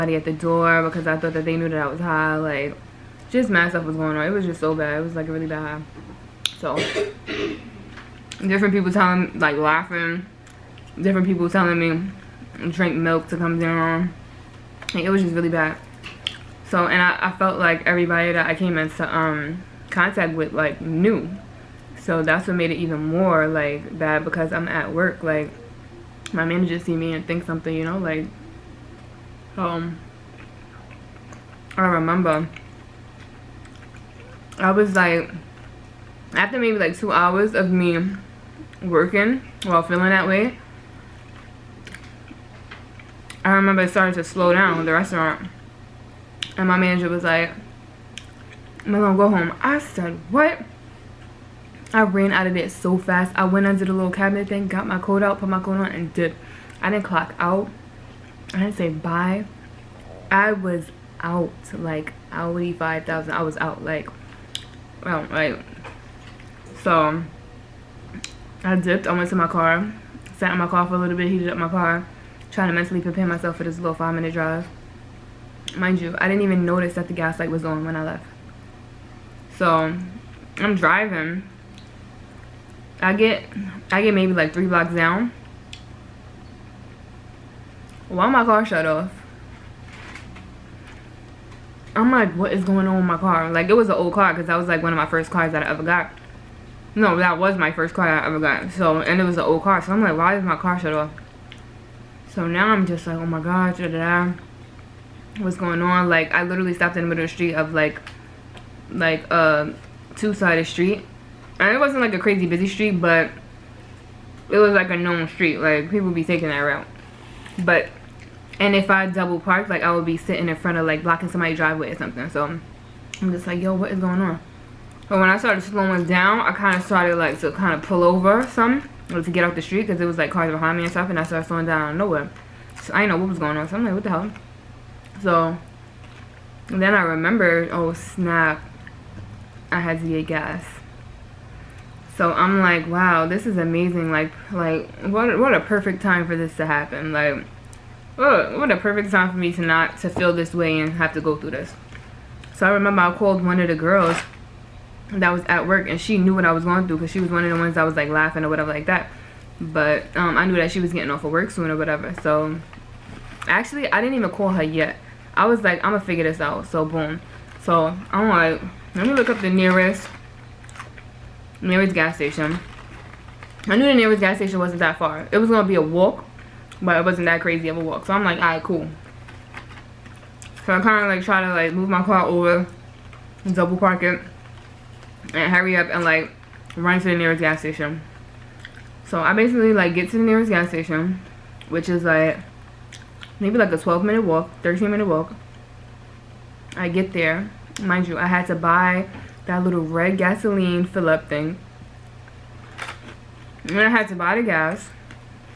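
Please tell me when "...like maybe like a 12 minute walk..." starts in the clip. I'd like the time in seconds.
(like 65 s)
192 s.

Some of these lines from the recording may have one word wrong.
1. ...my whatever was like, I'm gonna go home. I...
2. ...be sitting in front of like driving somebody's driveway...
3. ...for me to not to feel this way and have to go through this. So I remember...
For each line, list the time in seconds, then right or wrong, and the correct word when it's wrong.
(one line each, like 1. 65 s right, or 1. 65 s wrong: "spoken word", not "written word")
1. 46 s wrong: "manager", not "whatever"
2. 120 s wrong: "blocking", not "driving"
3. 149 s right.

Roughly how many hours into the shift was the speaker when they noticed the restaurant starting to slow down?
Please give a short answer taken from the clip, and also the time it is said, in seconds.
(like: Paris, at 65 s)
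2 hours, at 36 s.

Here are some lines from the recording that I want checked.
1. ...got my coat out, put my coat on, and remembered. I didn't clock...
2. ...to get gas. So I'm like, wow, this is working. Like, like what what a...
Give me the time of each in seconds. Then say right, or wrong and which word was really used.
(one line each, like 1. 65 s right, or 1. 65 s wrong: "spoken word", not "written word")
1. 54 s wrong: "dipped", not "remembered"
2. 139 s wrong: "amazing", not "working".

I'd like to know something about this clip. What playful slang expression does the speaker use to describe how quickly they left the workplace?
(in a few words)
outie 5,000.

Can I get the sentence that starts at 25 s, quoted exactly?
Like, my manager see me and think something, you know, like, um, I remember.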